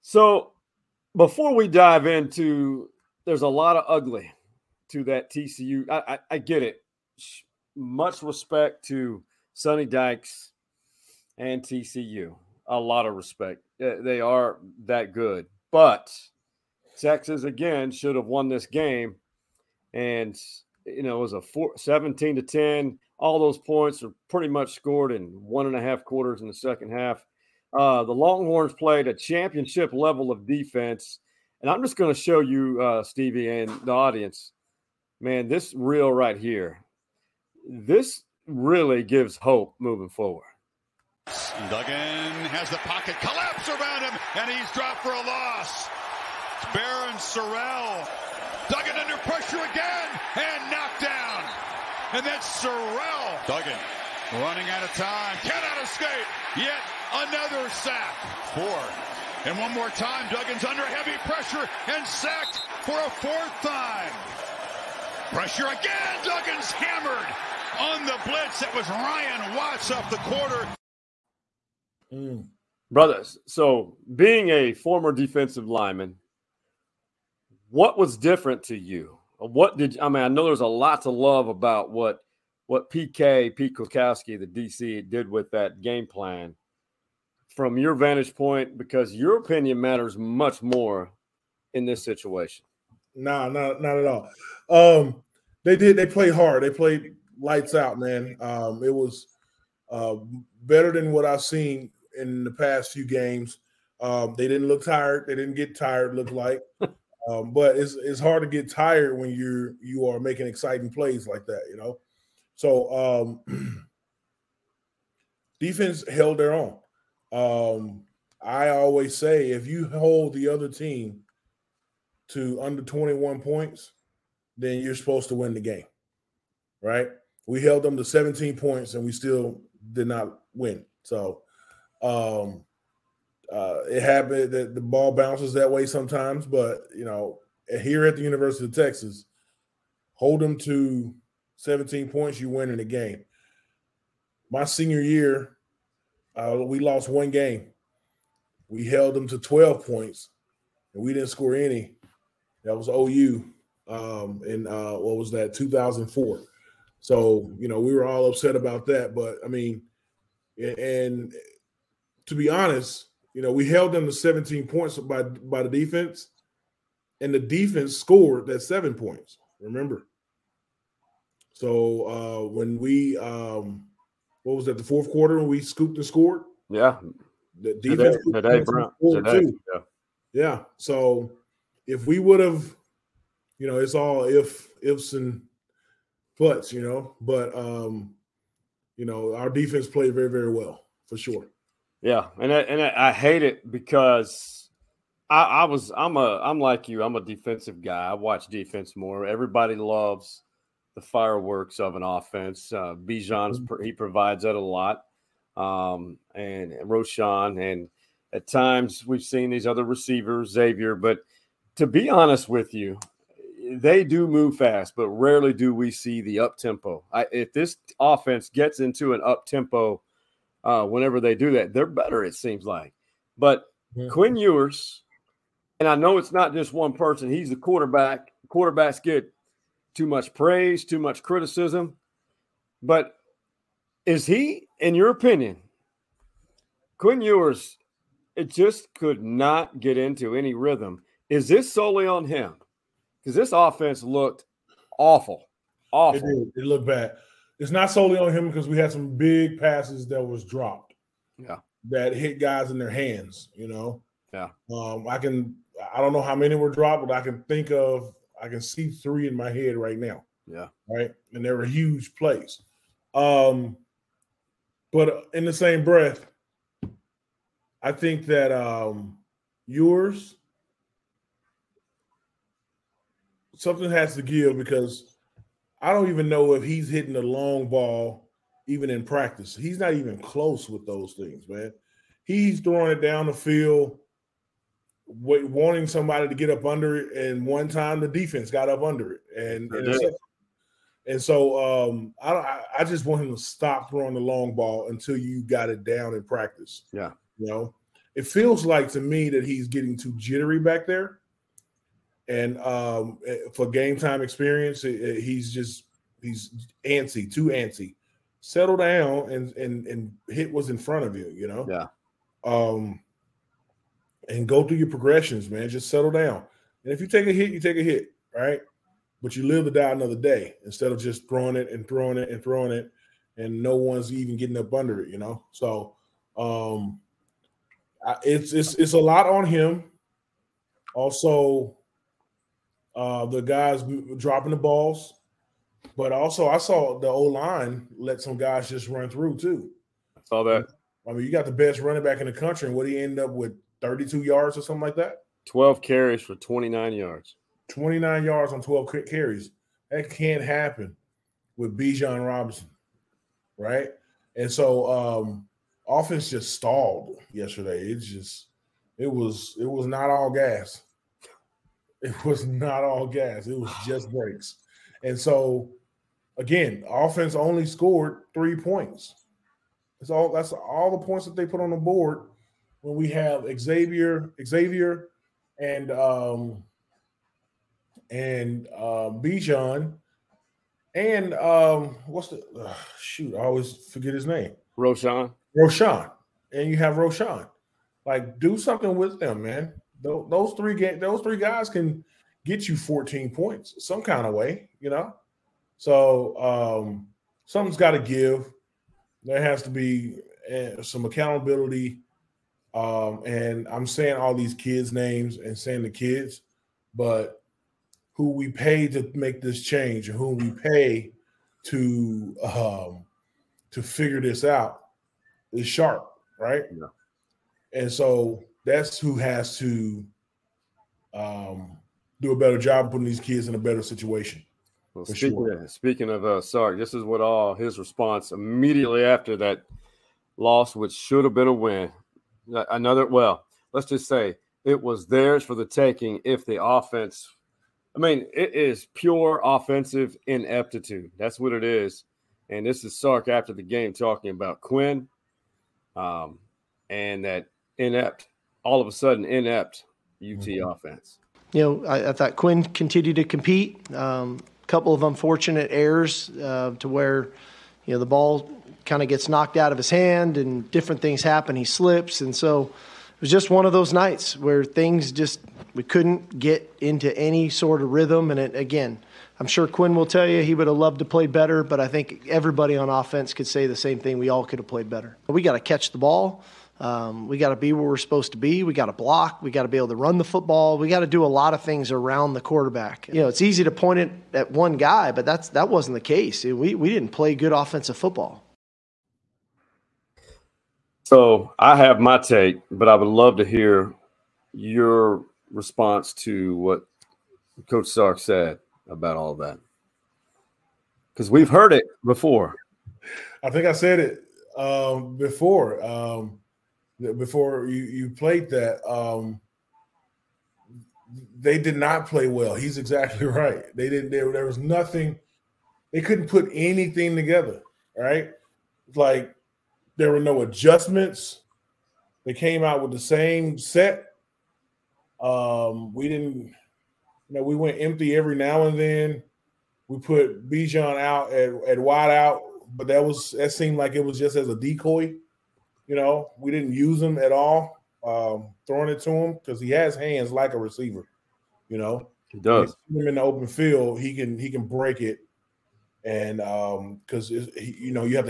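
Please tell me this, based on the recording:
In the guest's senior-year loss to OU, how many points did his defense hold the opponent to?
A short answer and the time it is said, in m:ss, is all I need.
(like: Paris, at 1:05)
12, at 2:29.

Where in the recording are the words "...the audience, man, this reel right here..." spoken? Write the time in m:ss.
0:33.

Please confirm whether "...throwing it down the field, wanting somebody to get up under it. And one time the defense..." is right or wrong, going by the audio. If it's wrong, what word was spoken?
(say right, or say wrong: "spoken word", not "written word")
right.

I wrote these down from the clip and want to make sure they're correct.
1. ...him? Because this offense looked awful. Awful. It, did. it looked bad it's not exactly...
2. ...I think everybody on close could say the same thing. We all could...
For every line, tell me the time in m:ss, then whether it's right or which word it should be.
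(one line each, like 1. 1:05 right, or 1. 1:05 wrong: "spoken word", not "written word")
1. 4:02 wrong: "solely", not "exactly"
2. 7:51 wrong: "offense", not "close".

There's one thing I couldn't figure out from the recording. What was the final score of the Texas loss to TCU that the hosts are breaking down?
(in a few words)
17 to 10.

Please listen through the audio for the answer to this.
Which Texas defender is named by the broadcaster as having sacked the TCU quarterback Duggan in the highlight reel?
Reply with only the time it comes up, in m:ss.
0:46.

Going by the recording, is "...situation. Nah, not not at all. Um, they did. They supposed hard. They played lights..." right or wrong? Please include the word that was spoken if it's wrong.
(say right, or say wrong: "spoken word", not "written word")
wrong: "played", not "supposed".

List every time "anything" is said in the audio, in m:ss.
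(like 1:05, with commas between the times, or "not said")
8:36.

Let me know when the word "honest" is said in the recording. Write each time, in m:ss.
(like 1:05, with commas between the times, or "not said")
2:42, 3:32.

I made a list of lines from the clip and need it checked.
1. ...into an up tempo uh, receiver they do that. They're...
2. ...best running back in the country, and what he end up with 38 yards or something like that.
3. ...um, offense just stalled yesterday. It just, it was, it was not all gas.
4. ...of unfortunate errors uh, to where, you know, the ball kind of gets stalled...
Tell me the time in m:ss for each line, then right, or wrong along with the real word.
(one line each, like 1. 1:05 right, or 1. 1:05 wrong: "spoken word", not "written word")
1. 3:38 wrong: "whenever", not "receiver"
2. 5:41 wrong: "32", not "38"
3. 5:54 right
4. 7:34 wrong: "knocked", not "stalled".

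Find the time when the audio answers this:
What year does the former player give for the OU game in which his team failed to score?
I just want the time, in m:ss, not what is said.
2:35.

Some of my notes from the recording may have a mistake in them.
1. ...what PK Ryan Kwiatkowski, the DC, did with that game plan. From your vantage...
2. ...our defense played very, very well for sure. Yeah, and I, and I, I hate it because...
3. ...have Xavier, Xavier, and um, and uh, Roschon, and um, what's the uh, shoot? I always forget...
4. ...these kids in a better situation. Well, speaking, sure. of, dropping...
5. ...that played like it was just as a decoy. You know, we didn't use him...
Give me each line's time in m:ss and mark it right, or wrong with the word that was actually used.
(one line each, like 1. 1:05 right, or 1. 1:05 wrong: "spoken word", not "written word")
1. 1:22 wrong: "Pete", not "Ryan"
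2. 3:09 right
3. 6:13 wrong: "Bijan", not "Roschon"
4. 7:03 wrong: "speaking", not "dropping"
5. 8:53 wrong: "seemed", not "played".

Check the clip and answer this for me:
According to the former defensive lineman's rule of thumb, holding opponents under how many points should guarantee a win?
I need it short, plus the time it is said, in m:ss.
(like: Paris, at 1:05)
21, at 2:02.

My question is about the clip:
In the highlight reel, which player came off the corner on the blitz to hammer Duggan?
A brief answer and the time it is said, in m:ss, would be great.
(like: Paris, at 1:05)
Ryan Watts, at 1:08.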